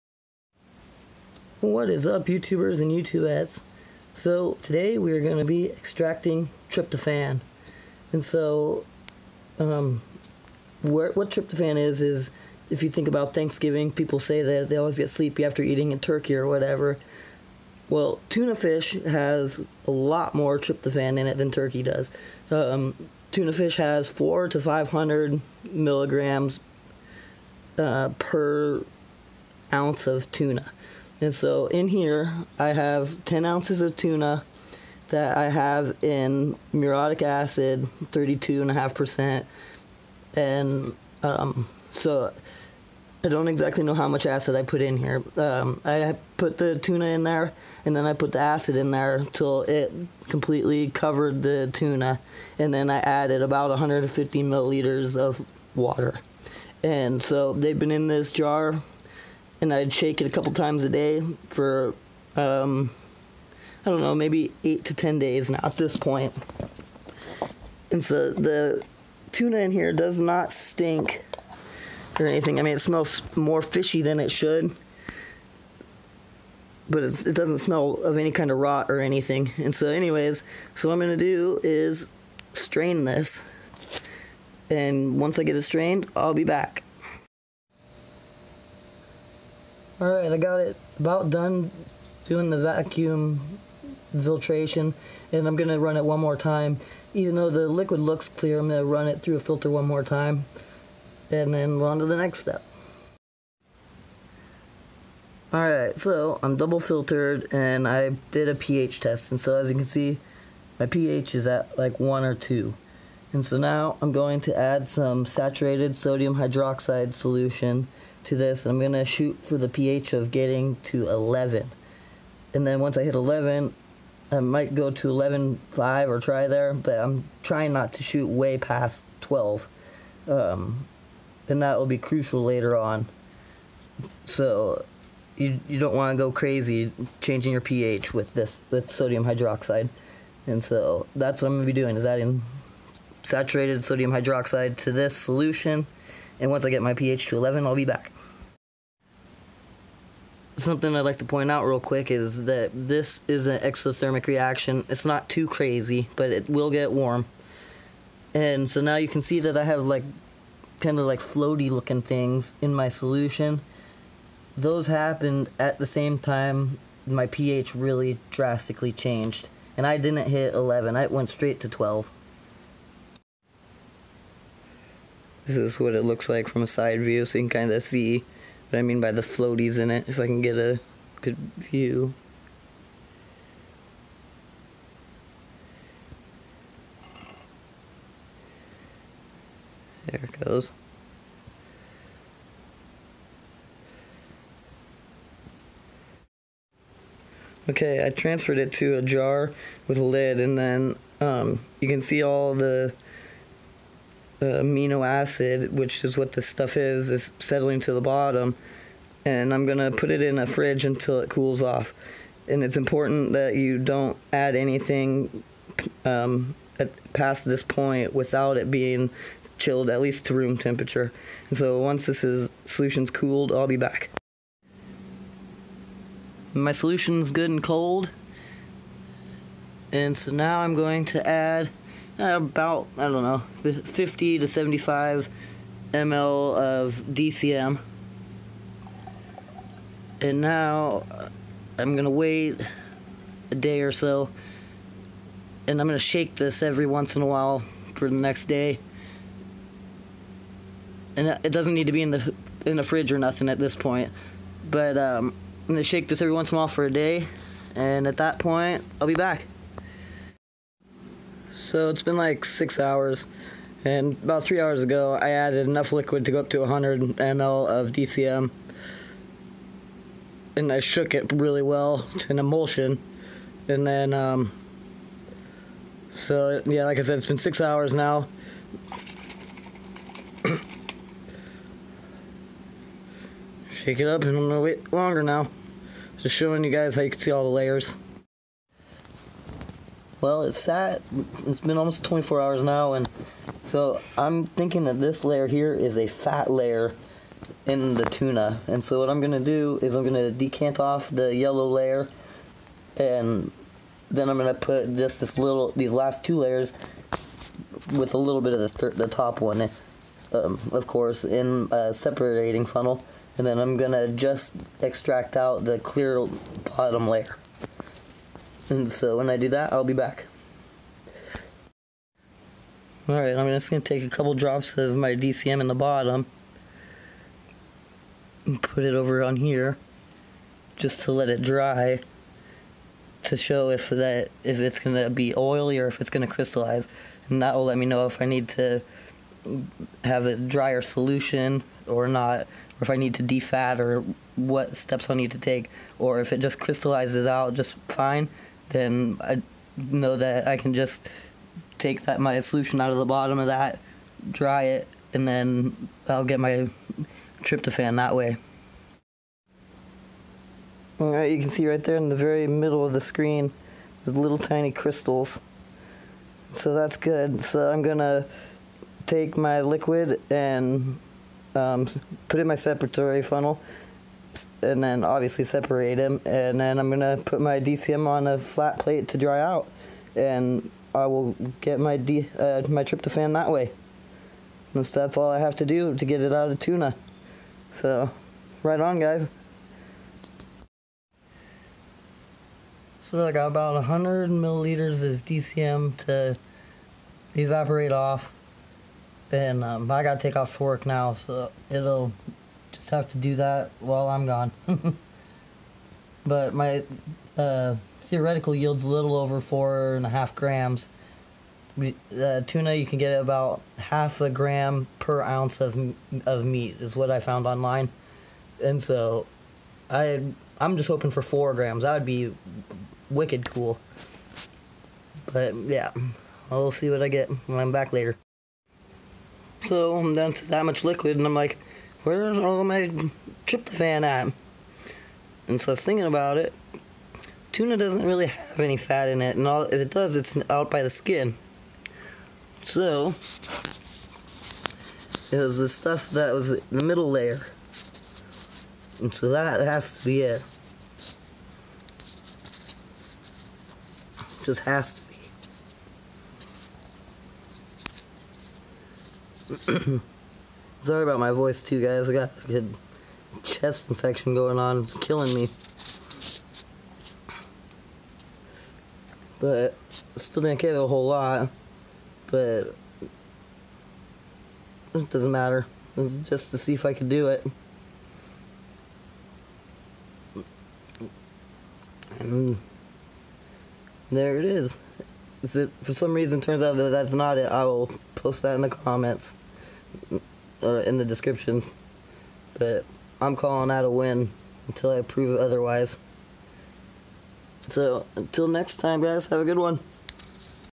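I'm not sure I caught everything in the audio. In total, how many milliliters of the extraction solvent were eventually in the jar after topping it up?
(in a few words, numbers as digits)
100 ml.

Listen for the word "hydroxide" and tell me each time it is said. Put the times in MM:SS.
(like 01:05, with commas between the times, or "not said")
01:56, 02:19, 02:24.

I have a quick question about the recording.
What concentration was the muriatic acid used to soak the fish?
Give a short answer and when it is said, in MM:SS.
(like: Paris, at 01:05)
32.5%, at 00:38.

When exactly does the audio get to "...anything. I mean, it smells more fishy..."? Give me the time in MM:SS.
01:12.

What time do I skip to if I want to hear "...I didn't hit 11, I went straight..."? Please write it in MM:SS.
02:49.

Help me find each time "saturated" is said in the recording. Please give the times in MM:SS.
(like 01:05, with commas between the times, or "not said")
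01:55, 02:23.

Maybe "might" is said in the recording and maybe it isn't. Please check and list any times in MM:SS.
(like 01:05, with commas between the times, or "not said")
02:04.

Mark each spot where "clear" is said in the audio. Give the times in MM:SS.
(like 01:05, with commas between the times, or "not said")
01:38, 05:15.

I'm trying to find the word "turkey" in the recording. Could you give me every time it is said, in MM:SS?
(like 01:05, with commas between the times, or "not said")
00:15, 00:21.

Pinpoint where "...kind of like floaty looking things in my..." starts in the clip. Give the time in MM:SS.
02:40.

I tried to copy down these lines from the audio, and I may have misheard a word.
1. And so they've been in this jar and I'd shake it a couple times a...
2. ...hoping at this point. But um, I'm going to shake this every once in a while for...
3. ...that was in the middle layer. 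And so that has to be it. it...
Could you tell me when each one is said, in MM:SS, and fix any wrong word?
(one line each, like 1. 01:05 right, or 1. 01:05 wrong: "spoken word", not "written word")
1. 00:56 right
2. 04:13 wrong: "nothing", not "hoping"
3. 07:26 right.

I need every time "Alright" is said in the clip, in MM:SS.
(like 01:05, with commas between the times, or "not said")
01:30, 01:45, 05:23.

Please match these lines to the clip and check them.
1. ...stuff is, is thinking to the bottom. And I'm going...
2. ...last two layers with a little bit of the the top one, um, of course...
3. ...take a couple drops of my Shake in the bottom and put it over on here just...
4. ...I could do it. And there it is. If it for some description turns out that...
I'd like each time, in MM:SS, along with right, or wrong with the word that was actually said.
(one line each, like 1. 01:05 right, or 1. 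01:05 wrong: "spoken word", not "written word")
1. 03:26 wrong: "settling", not "thinking"
2. 05:05 right
3. 05:23 wrong: "DCM", not "Shake"
4. 07:56 wrong: "reason", not "description".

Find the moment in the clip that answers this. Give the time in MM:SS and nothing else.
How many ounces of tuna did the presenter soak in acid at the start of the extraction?
00:33.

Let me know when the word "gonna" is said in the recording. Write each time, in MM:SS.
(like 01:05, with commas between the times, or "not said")
04:44, 06:07.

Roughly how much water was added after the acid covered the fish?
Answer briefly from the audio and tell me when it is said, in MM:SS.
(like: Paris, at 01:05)
150 milliliters, at 00:53.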